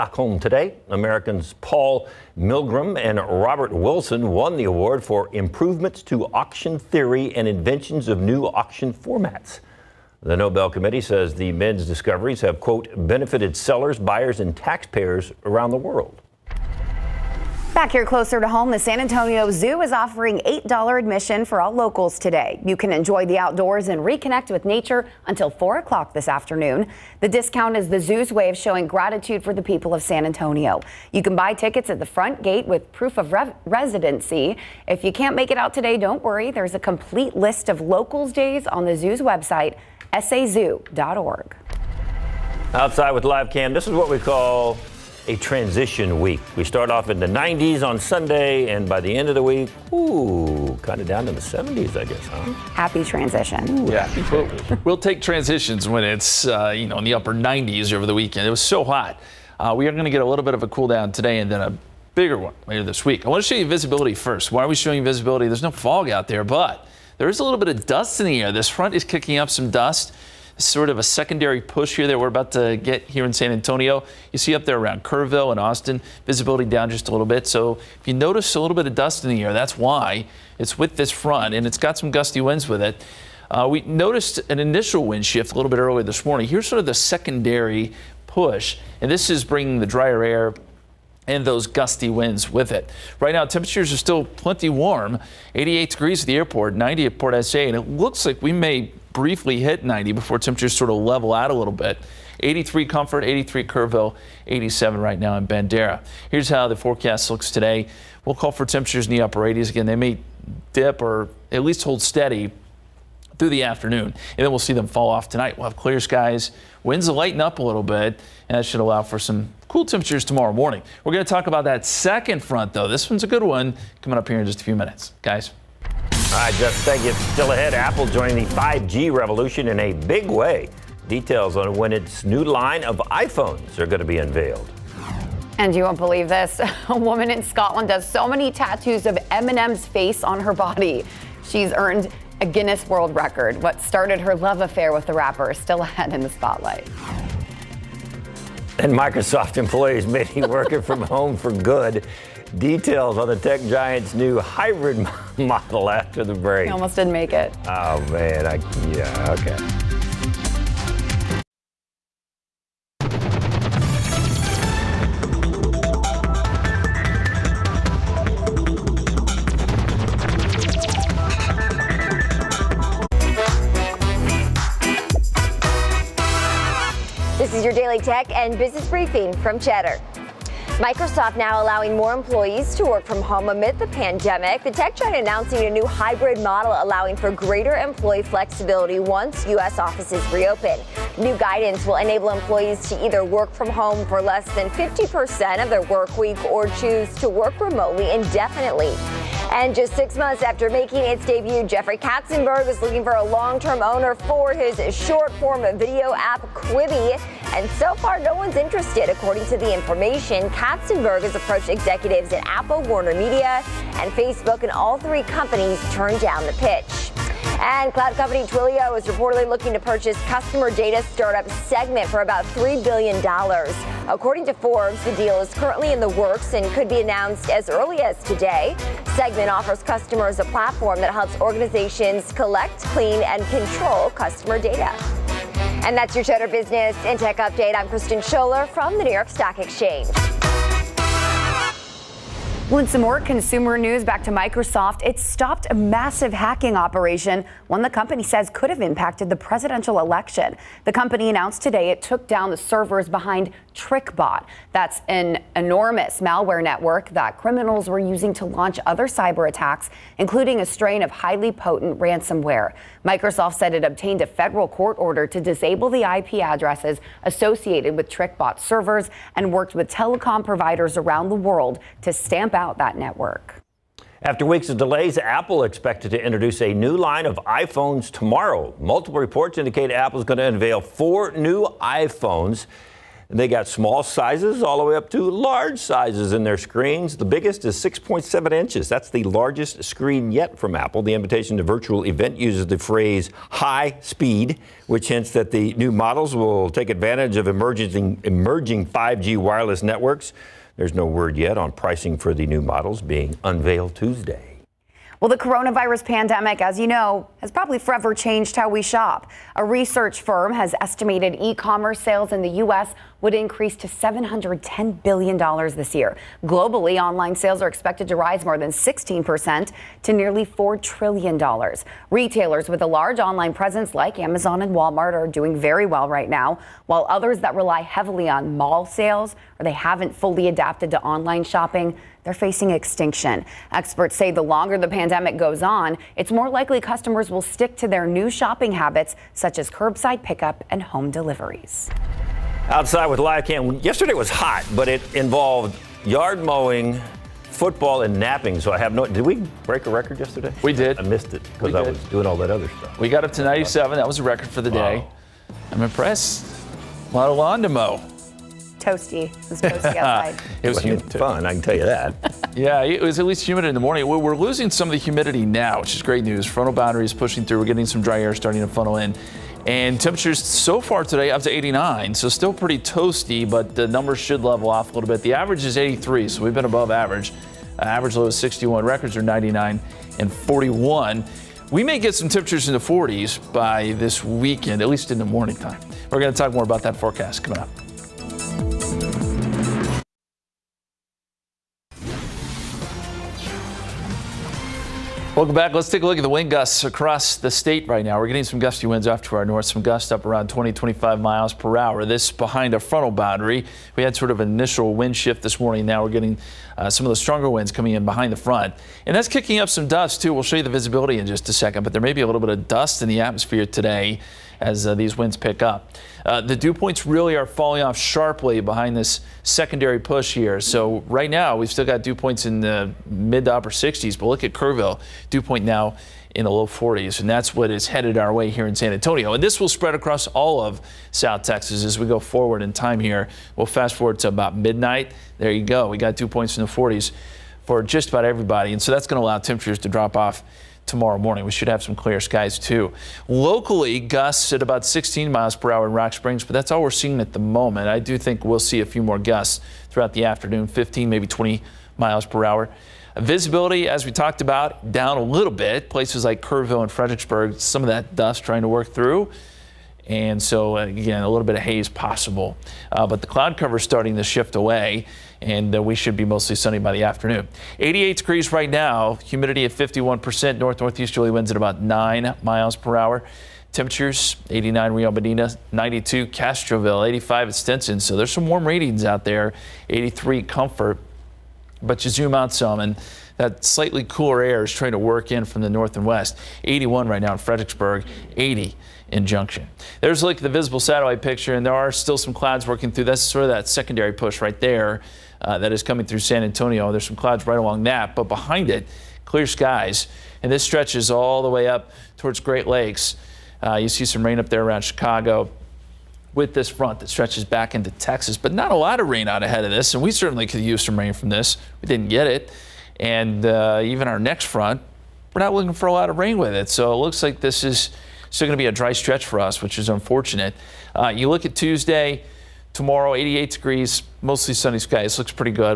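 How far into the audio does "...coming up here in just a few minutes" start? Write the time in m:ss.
2:04.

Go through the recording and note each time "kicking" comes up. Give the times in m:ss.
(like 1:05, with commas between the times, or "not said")
1:09, 6:49.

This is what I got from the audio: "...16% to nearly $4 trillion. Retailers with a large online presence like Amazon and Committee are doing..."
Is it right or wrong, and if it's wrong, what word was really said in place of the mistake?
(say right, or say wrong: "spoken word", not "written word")
wrong: "Walmart", not "Committee".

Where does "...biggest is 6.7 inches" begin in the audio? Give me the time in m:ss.
4:47.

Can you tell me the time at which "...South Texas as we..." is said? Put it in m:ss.
7:11.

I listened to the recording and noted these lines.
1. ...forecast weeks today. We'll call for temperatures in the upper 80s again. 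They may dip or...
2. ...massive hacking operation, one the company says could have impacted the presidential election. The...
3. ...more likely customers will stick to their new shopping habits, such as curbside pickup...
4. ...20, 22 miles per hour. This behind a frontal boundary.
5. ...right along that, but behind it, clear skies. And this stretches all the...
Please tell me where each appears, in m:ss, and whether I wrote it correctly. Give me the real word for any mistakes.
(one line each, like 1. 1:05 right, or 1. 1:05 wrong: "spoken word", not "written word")
1. 1:46 wrong: "looks", not "weeks"
2. 4:05 right
3. 5:36 right
4. 6:40 wrong: "25", not "22"
5. 8:17 right.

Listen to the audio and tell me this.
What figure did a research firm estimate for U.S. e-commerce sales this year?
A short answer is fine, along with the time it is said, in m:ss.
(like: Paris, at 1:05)
$710 billion, at 5:13.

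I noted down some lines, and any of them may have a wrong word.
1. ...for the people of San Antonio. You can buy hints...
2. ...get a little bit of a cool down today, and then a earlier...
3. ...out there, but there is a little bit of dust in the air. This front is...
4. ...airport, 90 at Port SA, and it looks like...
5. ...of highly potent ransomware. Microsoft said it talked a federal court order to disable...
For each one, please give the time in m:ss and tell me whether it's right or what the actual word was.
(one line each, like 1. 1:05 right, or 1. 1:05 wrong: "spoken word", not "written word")
1. 0:29 wrong: "tickets", not "hints"
2. 1:00 wrong: "bigger", not "earlier"
3. 1:06 right
4. 1:36 right
5. 4:21 wrong: "obtained", not "talked".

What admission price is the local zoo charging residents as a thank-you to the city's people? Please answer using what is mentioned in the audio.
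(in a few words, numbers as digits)
$8.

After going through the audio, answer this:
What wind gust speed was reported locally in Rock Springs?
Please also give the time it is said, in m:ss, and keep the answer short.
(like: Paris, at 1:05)
16 miles per hour, at 7:24.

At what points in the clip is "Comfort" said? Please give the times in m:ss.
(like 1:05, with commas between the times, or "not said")
1:42, 8:00.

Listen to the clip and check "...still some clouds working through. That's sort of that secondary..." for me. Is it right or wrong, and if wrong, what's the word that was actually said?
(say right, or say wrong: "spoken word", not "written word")
right.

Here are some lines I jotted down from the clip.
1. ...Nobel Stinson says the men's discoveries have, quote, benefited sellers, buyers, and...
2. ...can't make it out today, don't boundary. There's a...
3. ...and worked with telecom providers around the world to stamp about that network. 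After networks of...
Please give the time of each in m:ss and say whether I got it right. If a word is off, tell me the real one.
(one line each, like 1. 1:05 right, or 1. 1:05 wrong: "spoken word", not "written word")
1. 0:10 wrong: "Committee", not "Stinson"
2. 0:35 wrong: "worry", not "boundary"
3. 4:29 wrong: "weeks", not "networks".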